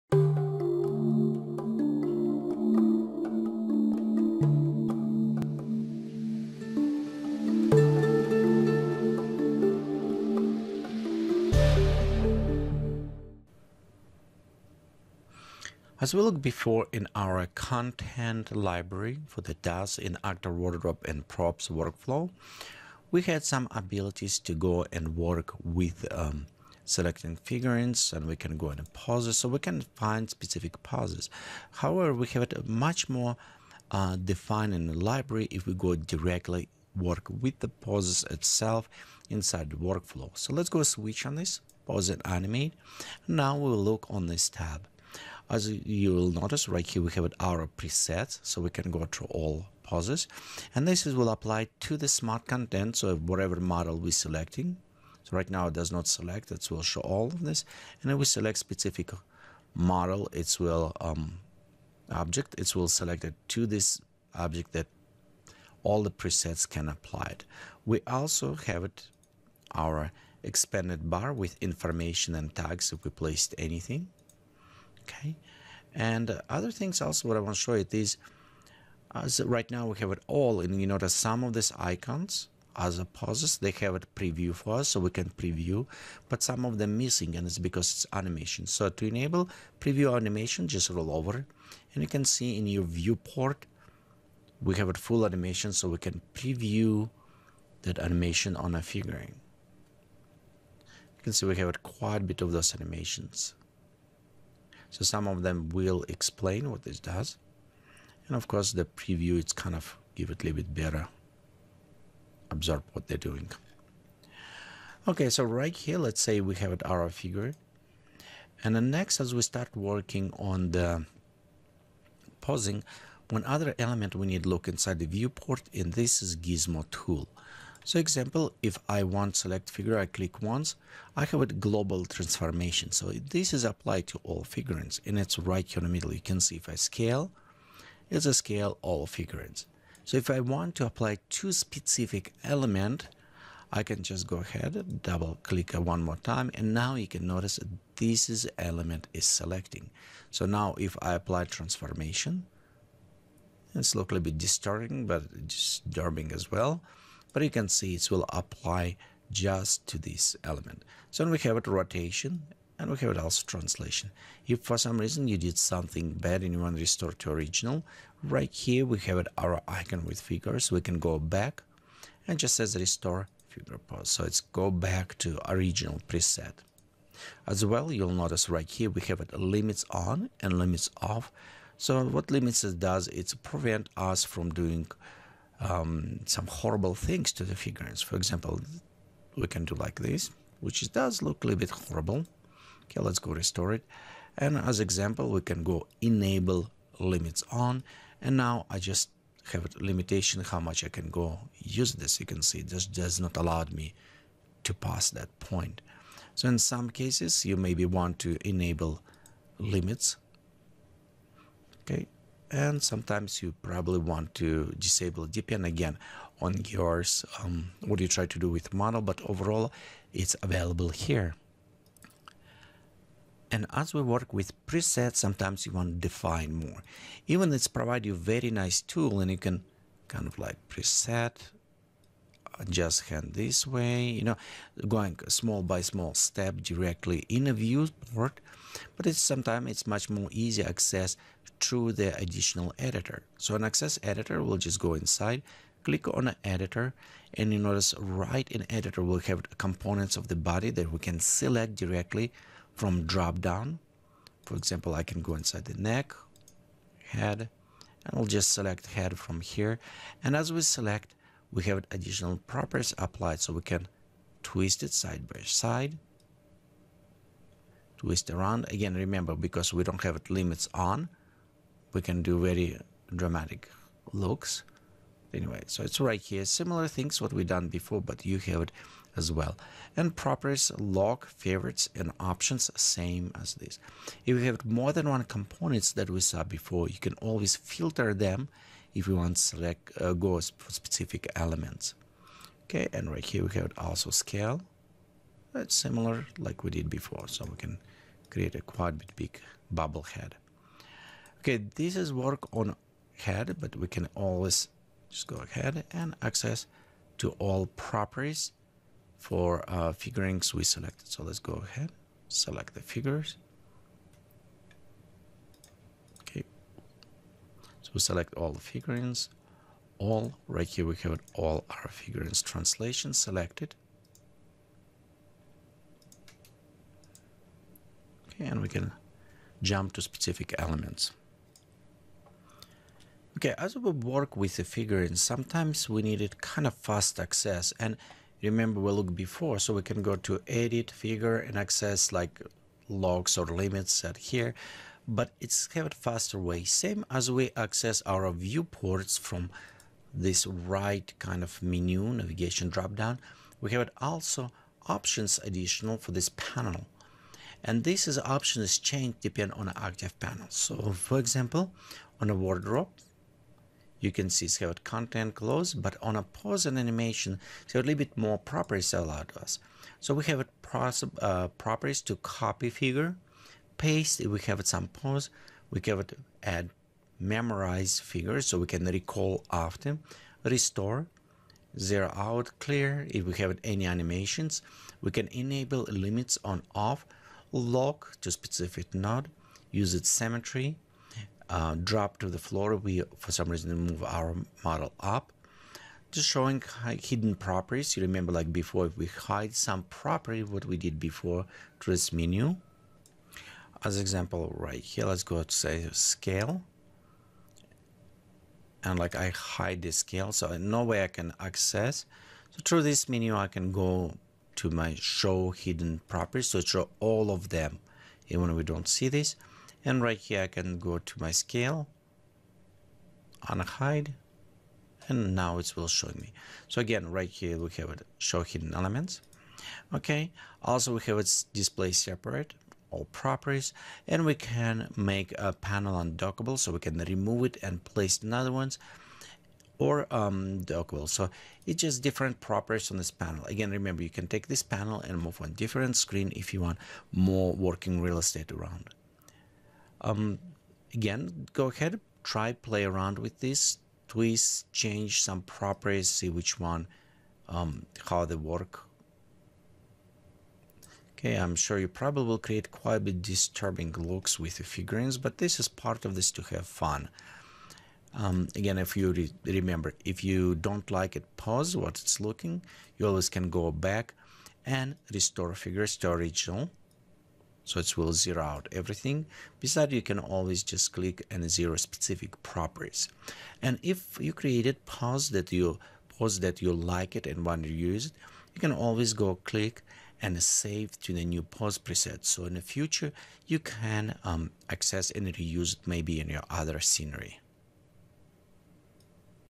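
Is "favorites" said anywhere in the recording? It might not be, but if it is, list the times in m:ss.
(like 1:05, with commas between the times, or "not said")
4:41.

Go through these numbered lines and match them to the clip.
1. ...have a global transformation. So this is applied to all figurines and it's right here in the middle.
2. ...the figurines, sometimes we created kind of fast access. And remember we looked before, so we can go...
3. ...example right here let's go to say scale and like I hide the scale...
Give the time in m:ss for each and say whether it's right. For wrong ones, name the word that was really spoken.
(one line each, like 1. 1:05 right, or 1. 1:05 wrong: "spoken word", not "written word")
1. 2:11 right
2. 5:34 wrong: "needed", not "created"
3. 6:43 right.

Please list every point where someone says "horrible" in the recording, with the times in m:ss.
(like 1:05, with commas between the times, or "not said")
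3:06, 3:11.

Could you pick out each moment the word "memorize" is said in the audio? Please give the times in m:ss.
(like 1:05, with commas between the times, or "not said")
6:17.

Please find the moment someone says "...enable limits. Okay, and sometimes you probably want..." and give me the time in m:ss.
3:28.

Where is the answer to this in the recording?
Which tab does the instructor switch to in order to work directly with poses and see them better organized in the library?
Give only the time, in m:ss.
0:41.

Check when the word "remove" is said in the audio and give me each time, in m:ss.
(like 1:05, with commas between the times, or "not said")
7:16.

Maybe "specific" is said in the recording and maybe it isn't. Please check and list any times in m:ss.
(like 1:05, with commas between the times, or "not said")
0:30, 0:58, 2:21, 4:50, 5:30, 6:28, 8:01.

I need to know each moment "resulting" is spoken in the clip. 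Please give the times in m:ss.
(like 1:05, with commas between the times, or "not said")
not said.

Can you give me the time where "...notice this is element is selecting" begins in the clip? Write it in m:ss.
2:27.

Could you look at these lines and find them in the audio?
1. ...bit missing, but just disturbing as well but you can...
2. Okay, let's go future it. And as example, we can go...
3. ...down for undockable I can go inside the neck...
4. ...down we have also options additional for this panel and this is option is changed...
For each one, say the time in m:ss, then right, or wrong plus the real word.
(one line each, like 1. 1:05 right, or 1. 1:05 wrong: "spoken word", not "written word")
1. 2:34 wrong: "disturbing", not "missing"
2. 3:12 wrong: "restore", not "future"
3. 4:13 wrong: "example", not "undockable"
4. 5:52 right.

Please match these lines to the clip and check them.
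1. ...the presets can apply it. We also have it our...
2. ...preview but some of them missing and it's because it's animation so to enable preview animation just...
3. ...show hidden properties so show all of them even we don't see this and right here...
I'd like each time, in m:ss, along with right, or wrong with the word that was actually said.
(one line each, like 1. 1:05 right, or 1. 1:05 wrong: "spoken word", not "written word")
1. 1:06 right
2. 1:25 right
3. 6:54 right.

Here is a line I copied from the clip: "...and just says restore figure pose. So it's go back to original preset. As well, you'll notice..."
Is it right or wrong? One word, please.
right.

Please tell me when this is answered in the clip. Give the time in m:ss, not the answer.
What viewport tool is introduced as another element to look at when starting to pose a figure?
2:06.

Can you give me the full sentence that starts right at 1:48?
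And of course, the preview, it's kind of give it a little bit better, absorb what they're doing.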